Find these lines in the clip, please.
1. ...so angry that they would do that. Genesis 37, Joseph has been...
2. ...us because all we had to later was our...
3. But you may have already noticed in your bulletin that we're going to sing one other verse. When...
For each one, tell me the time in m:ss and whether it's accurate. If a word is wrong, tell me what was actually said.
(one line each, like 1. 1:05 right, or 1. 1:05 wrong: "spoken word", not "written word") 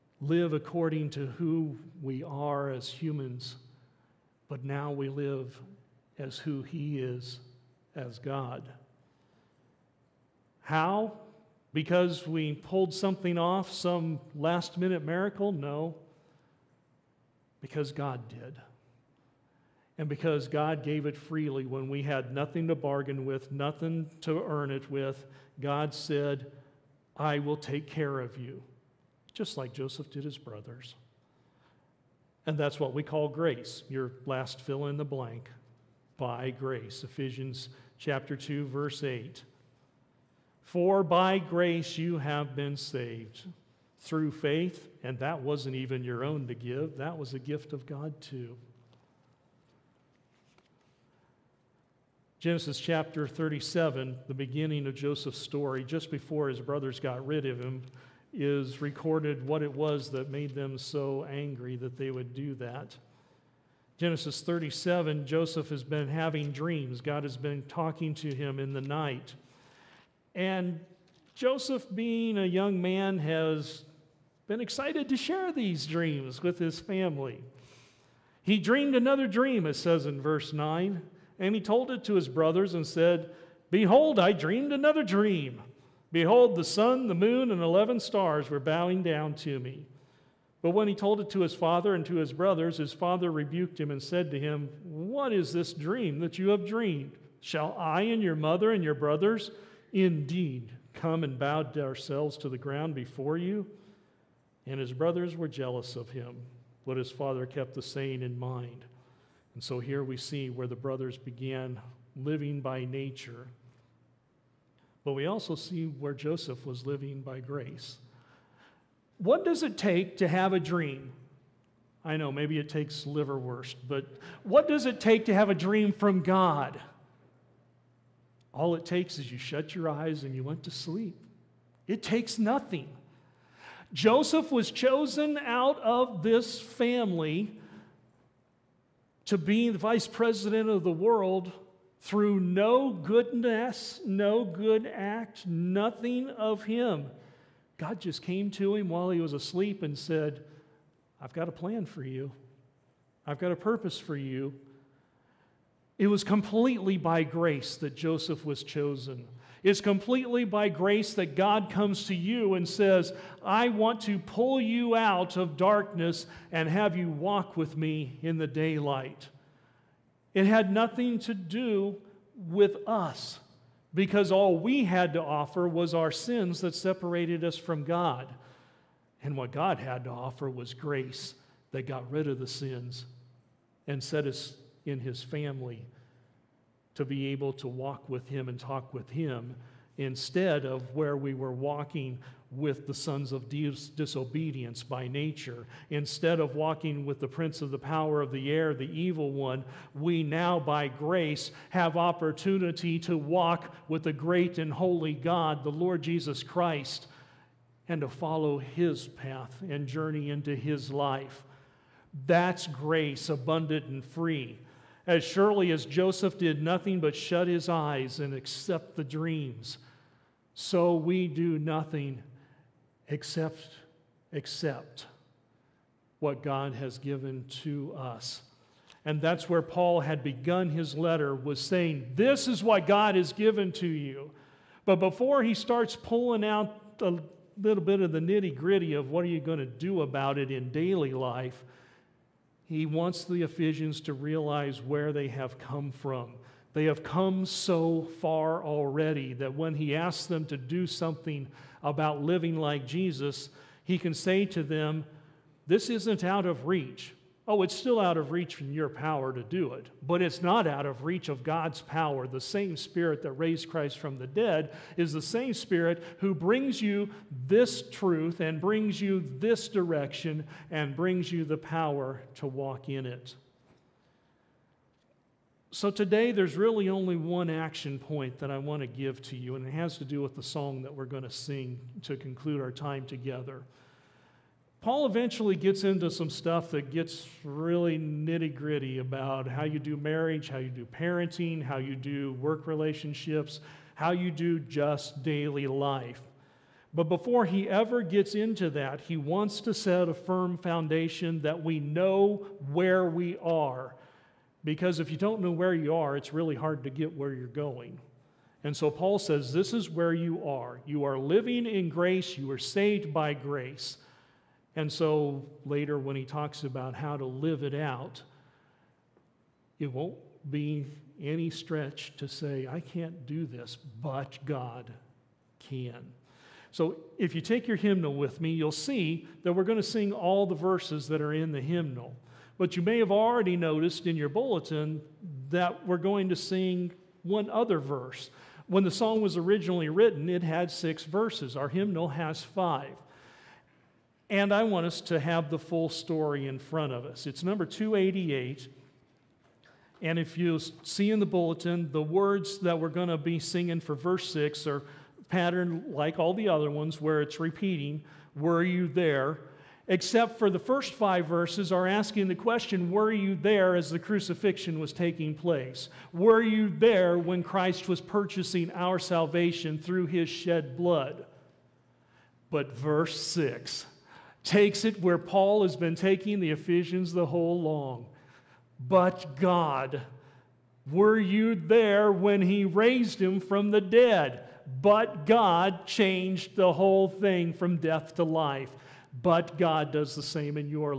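1. 1:00 right
2. 2:52 wrong: "offer", not "later"
3. 5:32 right.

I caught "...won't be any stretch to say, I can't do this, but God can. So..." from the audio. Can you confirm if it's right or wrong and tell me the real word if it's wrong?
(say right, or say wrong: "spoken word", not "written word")
right.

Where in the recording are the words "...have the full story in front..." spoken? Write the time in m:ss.
5:45.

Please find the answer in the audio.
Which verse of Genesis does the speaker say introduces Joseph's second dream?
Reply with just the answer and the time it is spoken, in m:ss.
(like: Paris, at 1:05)
verse 9, at 1:20.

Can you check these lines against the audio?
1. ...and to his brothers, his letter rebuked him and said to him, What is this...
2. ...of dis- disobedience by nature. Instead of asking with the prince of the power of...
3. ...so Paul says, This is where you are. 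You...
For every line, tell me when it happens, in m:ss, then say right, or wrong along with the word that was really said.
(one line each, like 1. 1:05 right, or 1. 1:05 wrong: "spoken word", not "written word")
1. 1:31 wrong: "father", not "letter"
2. 3:13 wrong: "walking", not "asking"
3. 5:08 right.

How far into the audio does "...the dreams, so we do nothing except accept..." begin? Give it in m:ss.
3:38.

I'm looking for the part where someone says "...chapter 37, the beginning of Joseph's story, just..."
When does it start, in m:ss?
0:52.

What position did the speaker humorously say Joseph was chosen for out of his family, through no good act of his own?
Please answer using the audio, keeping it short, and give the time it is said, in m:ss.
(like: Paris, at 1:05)
vice president of the world, at 2:19.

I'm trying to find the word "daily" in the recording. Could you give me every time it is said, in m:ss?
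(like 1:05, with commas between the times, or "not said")
4:00, 4:55.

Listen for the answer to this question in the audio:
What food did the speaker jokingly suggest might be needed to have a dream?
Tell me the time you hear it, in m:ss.
2:03.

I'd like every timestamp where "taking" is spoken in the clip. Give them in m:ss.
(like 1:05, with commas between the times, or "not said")
6:04, 6:15.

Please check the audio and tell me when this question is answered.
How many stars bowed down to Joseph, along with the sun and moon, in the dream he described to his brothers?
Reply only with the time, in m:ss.
1:27.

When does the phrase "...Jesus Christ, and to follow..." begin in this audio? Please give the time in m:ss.
3:26.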